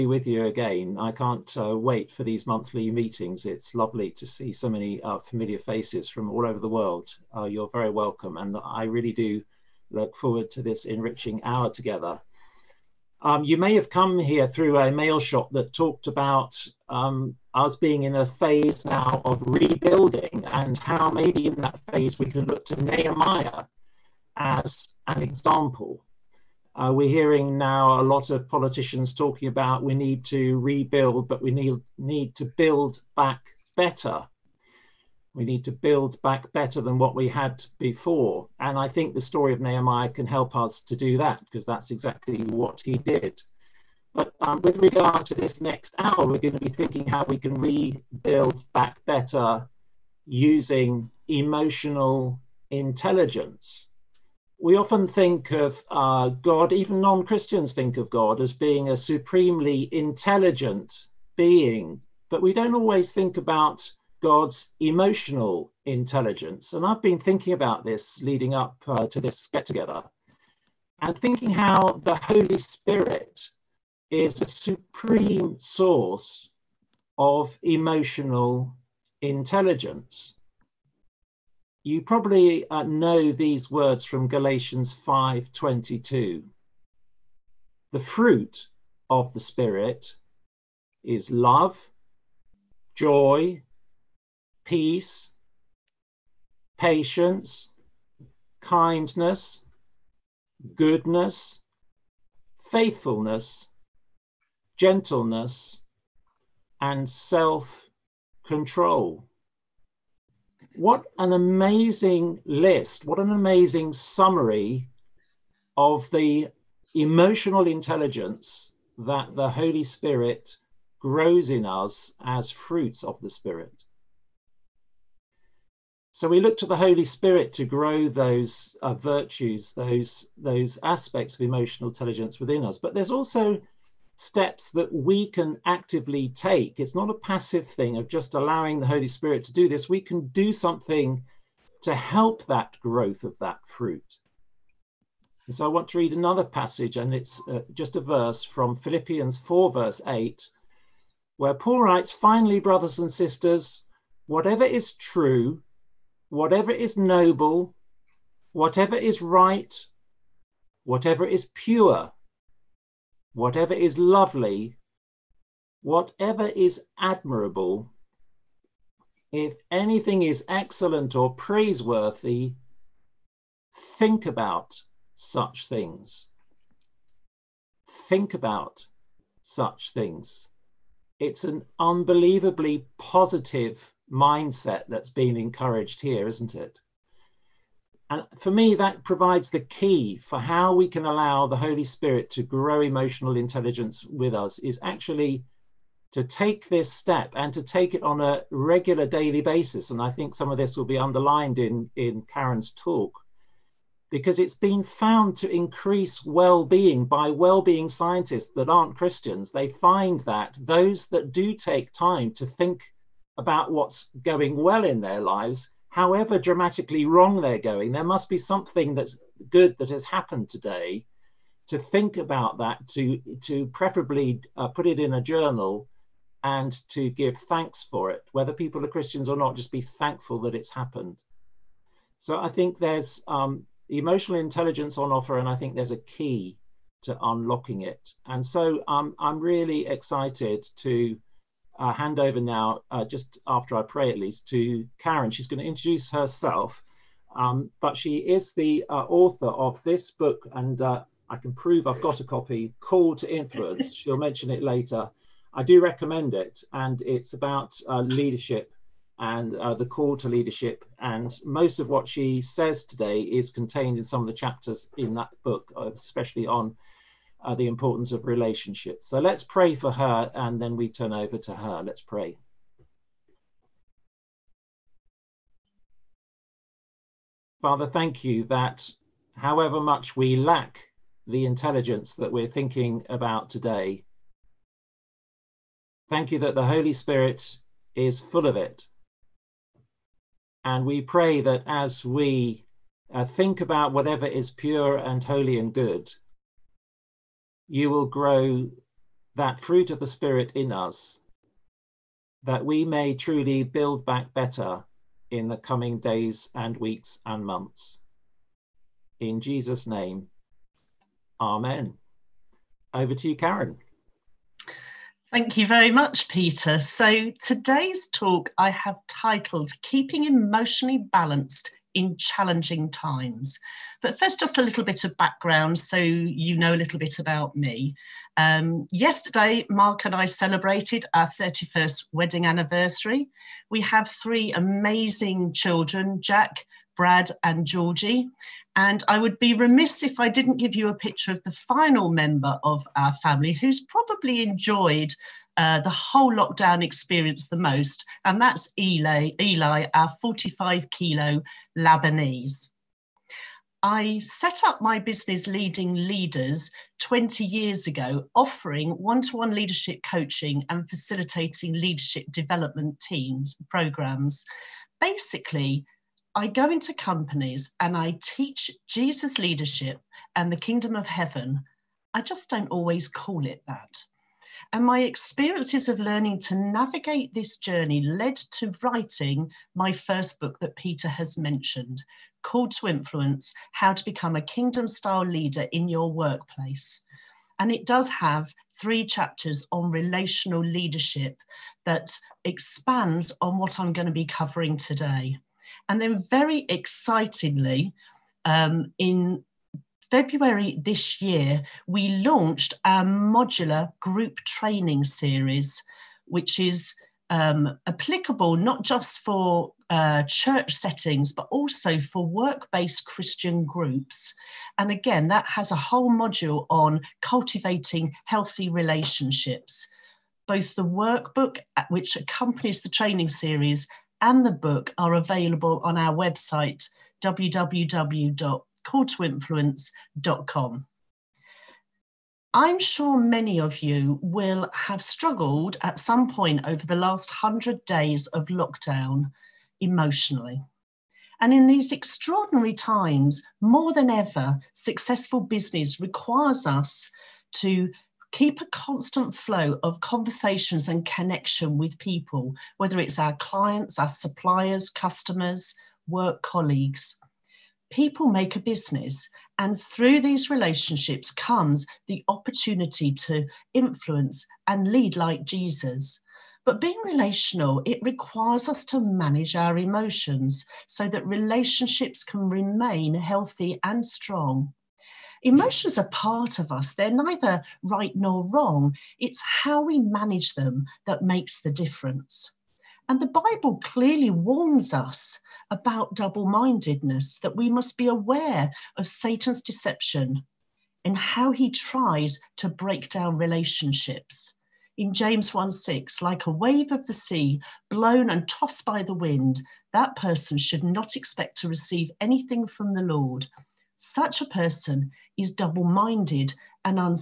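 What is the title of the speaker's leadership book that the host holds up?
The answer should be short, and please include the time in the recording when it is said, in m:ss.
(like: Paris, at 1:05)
Call to Influence, at 4:12.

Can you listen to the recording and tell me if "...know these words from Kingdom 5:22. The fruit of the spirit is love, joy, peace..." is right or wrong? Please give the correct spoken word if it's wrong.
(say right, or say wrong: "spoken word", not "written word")
wrong: "Galatians", not "Kingdom".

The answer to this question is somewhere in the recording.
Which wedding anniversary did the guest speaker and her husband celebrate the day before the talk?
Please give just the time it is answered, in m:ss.
5:31.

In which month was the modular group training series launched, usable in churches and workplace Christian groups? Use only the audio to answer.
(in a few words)
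February.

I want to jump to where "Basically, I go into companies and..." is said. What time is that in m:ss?
6:04.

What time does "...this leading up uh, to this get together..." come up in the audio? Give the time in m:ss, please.
1:07.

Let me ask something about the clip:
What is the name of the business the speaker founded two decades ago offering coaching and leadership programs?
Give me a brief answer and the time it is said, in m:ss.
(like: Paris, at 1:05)
Leading Leaders, at 5:55.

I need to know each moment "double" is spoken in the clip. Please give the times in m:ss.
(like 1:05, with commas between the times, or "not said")
8:06, 8:25.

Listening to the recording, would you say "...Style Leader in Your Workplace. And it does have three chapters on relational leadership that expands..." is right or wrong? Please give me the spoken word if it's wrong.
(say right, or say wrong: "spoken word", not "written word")
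right.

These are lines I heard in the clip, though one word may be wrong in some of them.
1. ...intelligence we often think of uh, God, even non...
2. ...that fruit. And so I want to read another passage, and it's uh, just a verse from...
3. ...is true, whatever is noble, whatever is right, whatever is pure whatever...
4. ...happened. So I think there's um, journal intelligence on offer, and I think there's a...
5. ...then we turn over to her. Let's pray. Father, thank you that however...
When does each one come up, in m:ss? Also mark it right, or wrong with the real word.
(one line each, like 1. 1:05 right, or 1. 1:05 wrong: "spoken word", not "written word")
1. 0:52 right
2. 2:23 right
3. 2:34 right
4. 3:50 wrong: "emotional", not "journal"
5. 4:30 right.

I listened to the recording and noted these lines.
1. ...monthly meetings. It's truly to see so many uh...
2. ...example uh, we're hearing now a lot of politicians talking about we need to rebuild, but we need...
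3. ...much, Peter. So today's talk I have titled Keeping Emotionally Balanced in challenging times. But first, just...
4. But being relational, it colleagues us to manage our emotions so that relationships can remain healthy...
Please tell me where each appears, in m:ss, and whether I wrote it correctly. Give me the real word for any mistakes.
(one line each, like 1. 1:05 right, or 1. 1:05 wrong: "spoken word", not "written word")
1. 0:02 wrong: "lovely", not "truly"
2. 0:25 right
3. 5:15 right
4. 7:46 wrong: "requires", not "colleagues".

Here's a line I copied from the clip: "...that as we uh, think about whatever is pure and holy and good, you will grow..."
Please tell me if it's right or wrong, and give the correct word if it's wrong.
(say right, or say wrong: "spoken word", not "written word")
right.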